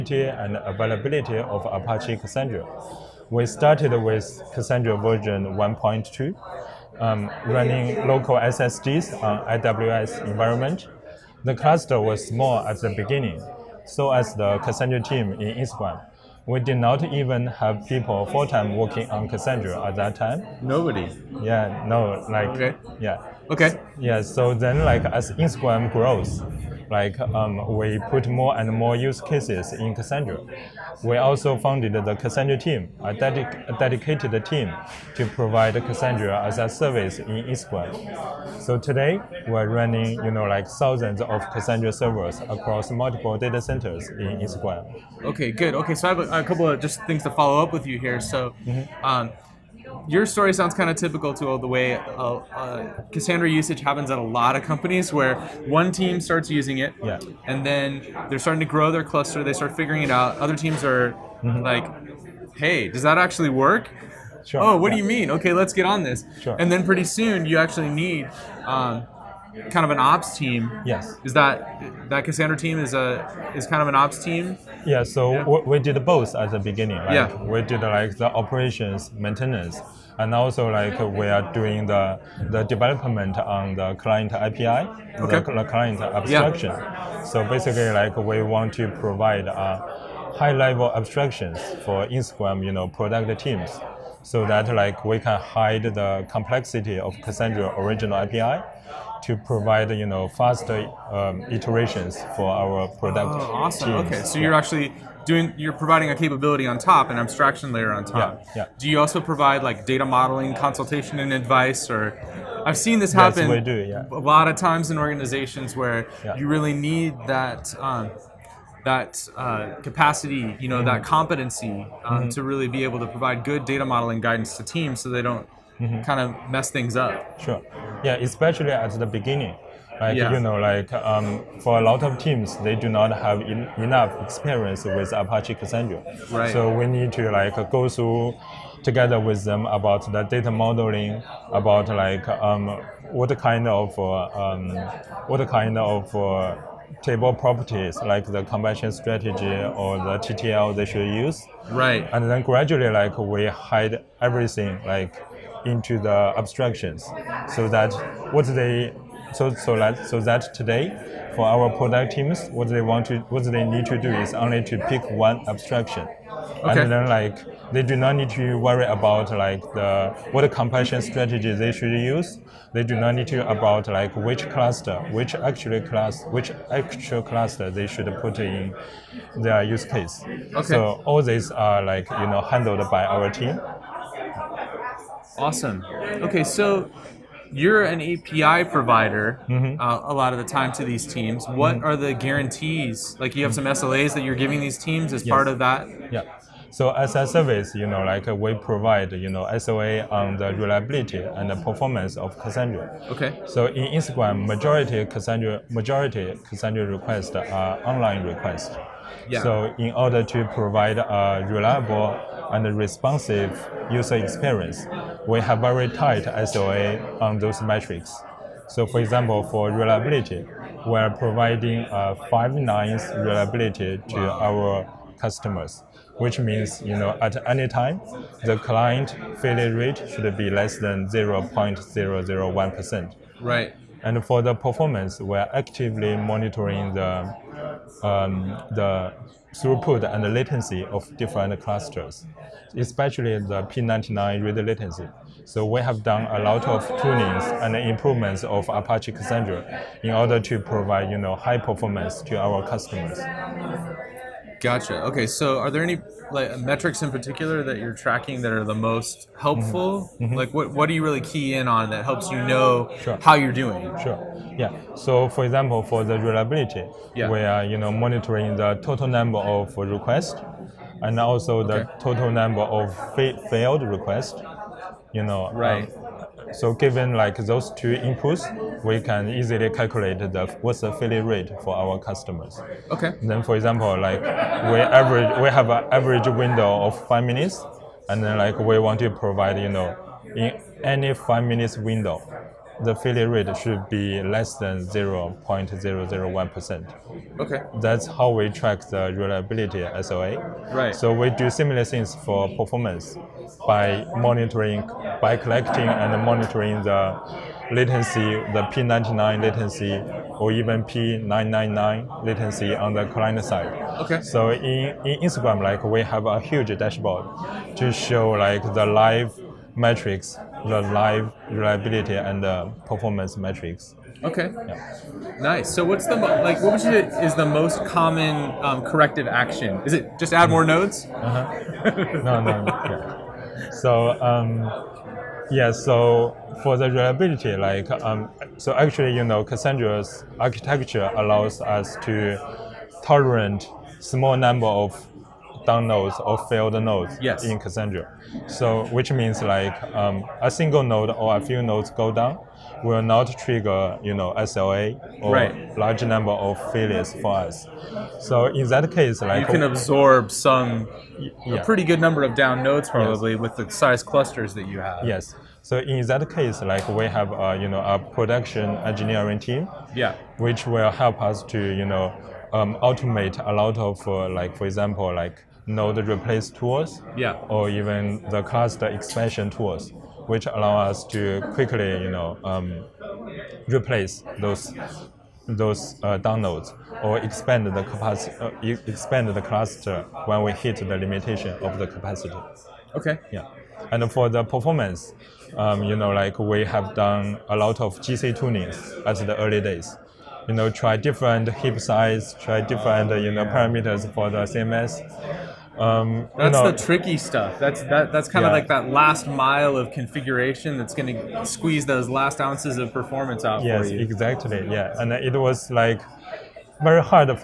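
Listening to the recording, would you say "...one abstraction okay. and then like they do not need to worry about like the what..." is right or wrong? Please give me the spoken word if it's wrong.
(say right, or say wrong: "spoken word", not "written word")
right.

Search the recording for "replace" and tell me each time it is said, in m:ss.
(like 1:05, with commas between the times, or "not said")
6:16, 6:23.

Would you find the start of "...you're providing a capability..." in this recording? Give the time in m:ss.
1:45.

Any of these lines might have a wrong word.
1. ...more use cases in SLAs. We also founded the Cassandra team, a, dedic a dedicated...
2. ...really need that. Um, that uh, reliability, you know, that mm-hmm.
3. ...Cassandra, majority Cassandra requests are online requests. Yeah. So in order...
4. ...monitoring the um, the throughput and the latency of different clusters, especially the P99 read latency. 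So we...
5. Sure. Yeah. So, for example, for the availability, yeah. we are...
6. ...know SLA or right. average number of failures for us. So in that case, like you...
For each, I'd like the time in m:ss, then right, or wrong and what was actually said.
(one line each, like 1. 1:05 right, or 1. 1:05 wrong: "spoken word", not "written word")
1. 0:28 wrong: "Cassandra", not "SLAs"
2. 1:56 wrong: "capacity", not "reliability"
3. 3:25 right
4. 3:56 right
5. 4:24 wrong: "reliability", not "availability"
6. 5:54 wrong: "large", not "average".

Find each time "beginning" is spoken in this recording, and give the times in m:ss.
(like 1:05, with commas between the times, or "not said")
0:12, 1:16, 2:09.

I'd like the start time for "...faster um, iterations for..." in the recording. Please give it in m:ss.
1:40.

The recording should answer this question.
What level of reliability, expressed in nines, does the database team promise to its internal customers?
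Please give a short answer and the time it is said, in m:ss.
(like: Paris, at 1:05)
five nines, at 3:42.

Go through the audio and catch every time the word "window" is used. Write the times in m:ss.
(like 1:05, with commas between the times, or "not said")
4:46, 4:51.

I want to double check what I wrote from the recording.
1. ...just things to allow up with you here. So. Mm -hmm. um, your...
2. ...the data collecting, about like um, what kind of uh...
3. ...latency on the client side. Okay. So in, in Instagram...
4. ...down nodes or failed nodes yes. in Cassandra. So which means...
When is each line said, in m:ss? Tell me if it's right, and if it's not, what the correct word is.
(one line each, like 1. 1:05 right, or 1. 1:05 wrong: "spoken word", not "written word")
1. 0:46 wrong: "follow", not "allow"
2. 2:20 wrong: "modeling", not "collecting"
3. 5:12 right
4. 5:45 right.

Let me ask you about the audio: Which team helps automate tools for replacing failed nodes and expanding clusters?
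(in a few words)
production engineering team.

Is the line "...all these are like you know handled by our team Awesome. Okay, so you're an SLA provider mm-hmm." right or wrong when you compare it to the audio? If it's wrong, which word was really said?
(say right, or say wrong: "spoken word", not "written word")
wrong: "API", not "SLA".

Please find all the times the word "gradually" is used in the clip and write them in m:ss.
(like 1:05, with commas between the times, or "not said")
2:32.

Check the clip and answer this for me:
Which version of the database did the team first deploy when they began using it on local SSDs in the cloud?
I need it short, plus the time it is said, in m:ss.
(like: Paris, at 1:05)
1.2, at 0:04.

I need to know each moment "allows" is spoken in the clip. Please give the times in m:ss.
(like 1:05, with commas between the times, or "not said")
5:41, 6:20.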